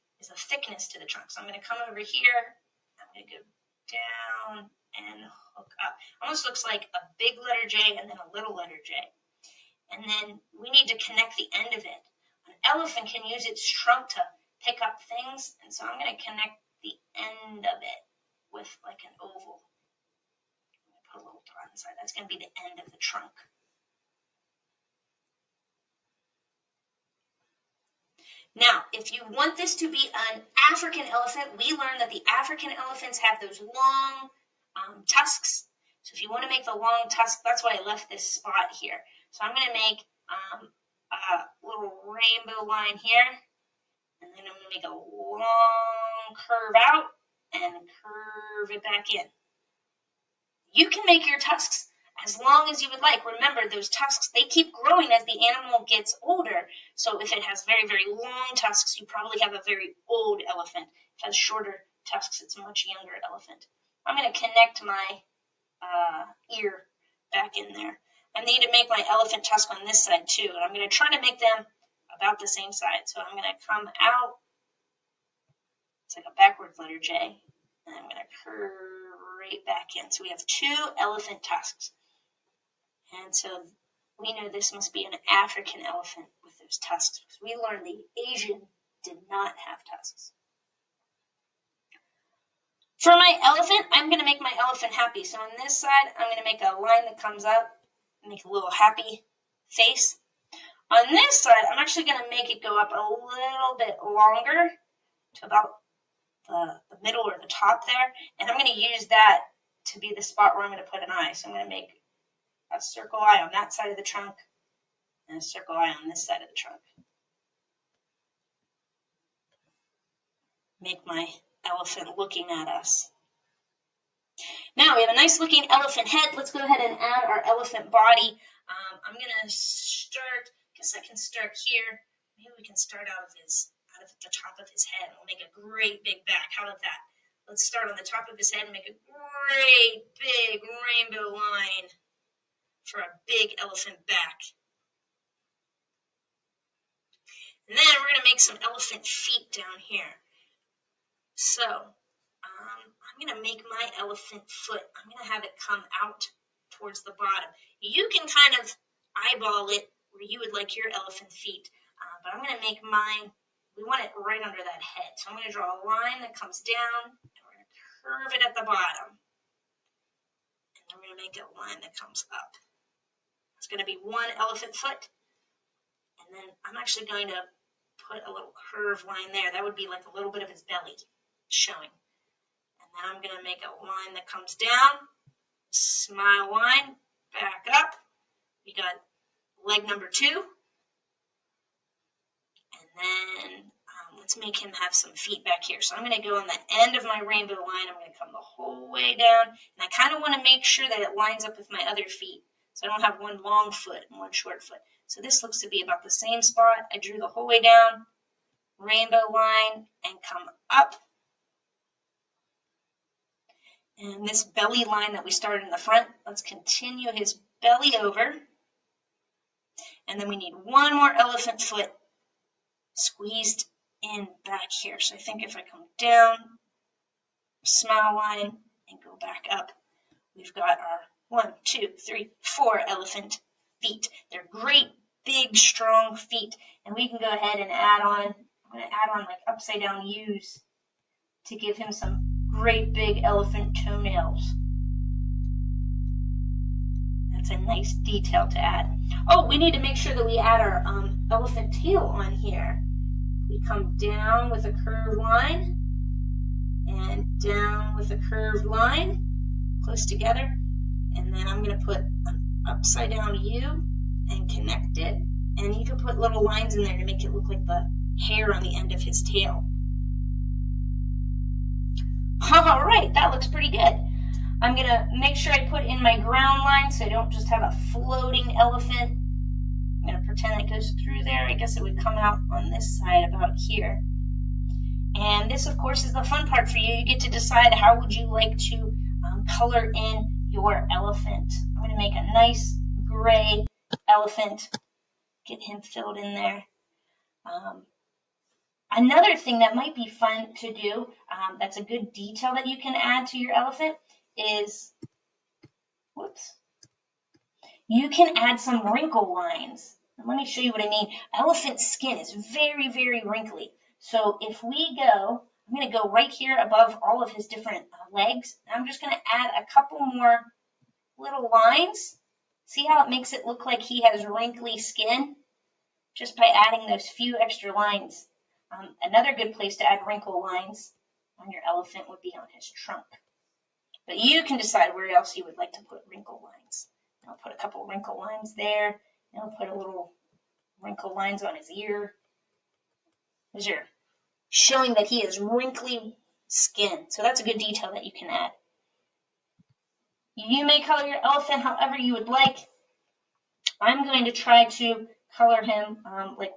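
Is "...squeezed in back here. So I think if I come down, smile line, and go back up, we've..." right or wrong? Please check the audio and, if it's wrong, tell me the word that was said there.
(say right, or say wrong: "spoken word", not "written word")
right.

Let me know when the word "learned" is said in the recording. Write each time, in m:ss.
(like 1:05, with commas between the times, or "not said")
0:31, 1:27.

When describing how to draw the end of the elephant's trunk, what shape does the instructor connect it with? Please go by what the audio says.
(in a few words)
An oval.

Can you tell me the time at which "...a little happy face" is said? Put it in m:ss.
1:38.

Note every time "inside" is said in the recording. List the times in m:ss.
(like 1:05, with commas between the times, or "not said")
0:21.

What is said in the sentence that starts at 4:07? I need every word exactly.
That's a nice detail to add.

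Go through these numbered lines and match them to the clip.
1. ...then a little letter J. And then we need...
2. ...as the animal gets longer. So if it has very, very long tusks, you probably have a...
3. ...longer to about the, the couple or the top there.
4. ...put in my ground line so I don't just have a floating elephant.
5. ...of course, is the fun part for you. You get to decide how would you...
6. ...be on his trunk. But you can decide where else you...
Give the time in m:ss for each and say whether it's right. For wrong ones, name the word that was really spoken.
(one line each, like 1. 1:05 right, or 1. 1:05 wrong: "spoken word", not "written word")
1. 0:08 right
2. 0:55 wrong: "older", not "longer"
3. 1:44 wrong: "middle", not "couple"
4. 4:35 right
5. 4:45 right
6. 5:32 right.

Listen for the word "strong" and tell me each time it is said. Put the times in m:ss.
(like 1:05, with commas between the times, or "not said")
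3:55.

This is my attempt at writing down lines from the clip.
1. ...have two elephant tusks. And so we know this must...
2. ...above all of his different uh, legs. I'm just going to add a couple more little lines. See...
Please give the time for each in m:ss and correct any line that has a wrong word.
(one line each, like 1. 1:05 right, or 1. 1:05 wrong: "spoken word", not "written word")
1. 1:20 right
2. 5:16 right.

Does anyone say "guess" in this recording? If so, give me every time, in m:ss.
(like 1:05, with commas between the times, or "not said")
2:10, 4:41.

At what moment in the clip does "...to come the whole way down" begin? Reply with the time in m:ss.
3:18.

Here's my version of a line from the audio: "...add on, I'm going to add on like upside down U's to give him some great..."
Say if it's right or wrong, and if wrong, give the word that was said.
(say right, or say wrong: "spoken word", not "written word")
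right.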